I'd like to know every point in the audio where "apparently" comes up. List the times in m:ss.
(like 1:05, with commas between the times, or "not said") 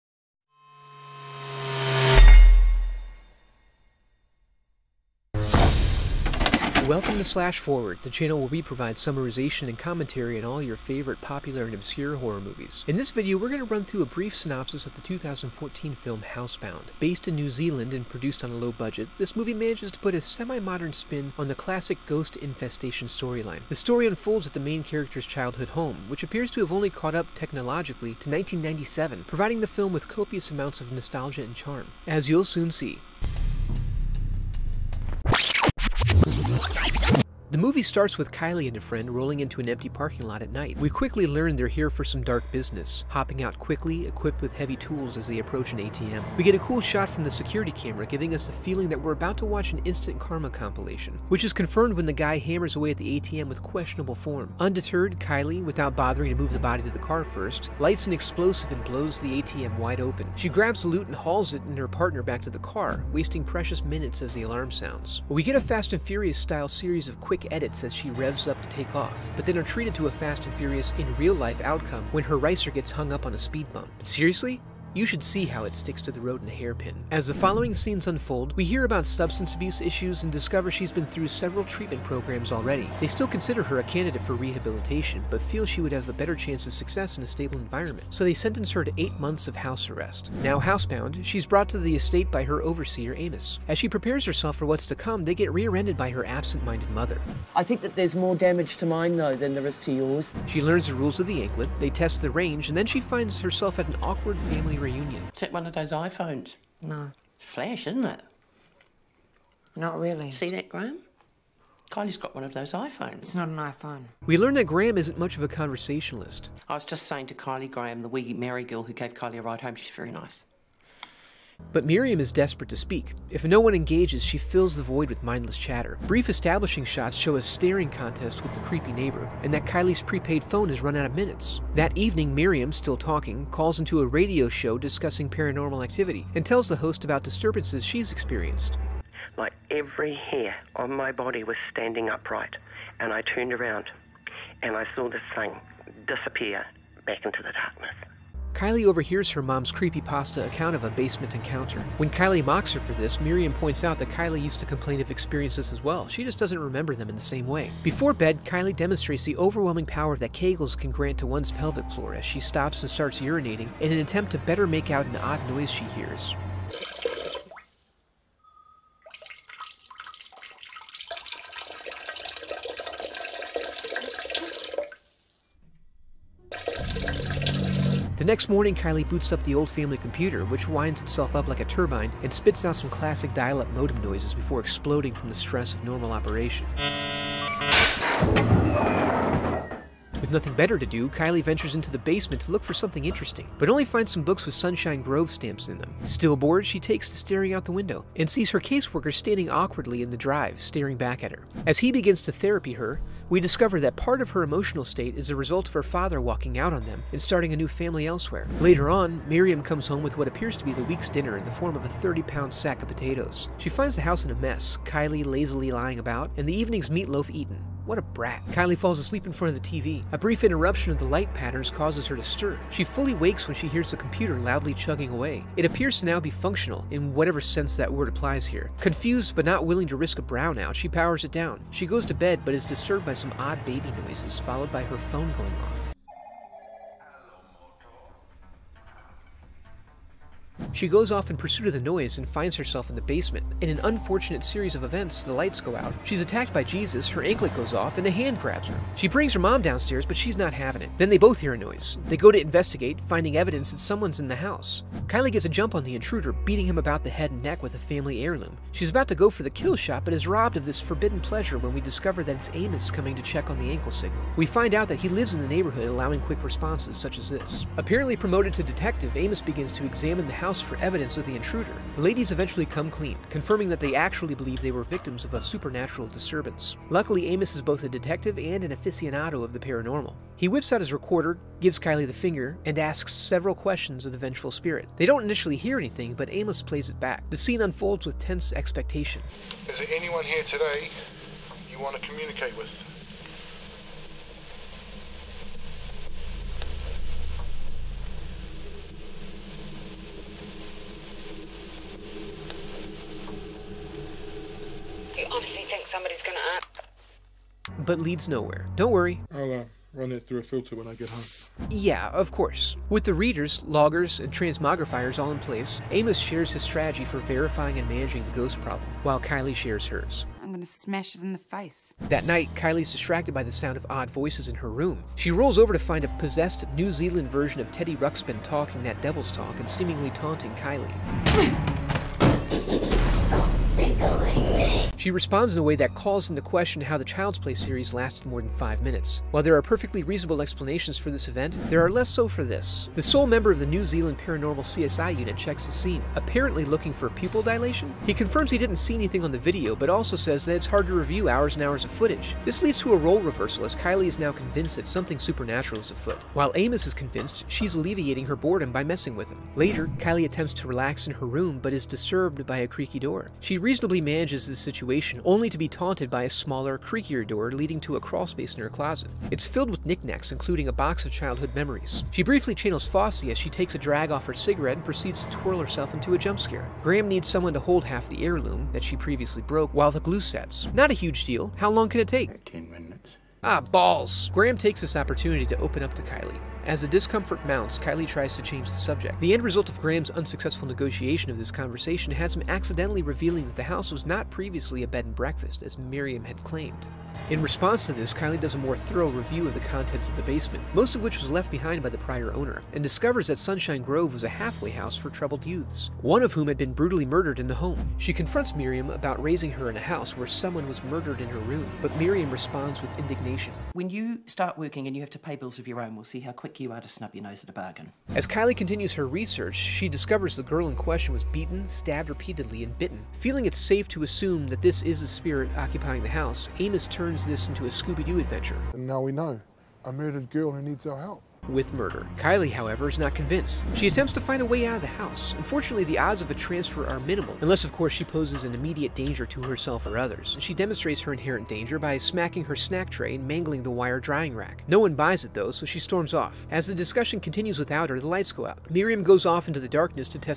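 4:27, 5:46.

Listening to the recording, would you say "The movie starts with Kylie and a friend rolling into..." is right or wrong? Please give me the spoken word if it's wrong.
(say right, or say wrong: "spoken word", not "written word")
right.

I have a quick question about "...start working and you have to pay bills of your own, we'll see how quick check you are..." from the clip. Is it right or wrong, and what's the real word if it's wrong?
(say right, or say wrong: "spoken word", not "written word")
wrong: "quick", not "check".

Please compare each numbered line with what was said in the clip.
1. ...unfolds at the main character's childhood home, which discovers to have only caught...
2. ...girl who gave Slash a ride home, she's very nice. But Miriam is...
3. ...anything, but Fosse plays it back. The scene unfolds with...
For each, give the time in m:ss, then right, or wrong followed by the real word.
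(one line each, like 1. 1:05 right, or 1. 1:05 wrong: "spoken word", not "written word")
1. 0:24 wrong: "appears", not "discovers"
2. 1:58 wrong: "Kylie", not "Slash"
3. 4:45 wrong: "Amos", not "Fosse".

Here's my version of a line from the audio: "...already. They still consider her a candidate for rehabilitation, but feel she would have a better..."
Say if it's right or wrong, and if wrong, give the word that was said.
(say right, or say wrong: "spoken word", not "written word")
right.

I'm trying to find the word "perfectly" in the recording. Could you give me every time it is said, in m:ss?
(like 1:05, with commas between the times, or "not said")
5:39.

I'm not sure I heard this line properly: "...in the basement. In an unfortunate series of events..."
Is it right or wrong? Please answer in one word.
right.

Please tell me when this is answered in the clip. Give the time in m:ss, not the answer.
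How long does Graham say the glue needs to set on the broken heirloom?
6:22.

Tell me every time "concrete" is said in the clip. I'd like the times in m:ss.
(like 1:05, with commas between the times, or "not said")
not said.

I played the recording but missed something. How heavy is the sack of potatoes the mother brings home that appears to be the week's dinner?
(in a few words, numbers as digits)
30 pounds.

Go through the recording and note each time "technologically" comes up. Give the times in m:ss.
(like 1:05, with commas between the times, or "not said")
0:27.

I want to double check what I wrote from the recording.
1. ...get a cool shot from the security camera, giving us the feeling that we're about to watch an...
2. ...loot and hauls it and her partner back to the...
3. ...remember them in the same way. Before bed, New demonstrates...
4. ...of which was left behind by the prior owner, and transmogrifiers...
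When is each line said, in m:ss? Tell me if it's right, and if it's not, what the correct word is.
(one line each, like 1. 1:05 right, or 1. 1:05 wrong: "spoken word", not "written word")
1. 0:46 right
2. 1:00 right
3. 2:36 wrong: "Kylie", not "New"
4. 6:40 wrong: "discovers", not "transmogrifiers".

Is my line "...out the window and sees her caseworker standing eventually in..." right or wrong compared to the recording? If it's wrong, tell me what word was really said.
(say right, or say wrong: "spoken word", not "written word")
wrong: "awkwardly", not "eventually".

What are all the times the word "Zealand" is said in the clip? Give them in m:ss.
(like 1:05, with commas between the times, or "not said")
0:17, 5:26, 5:43.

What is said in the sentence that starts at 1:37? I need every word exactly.
I think that there's more damage to mine, though, than there is to yours.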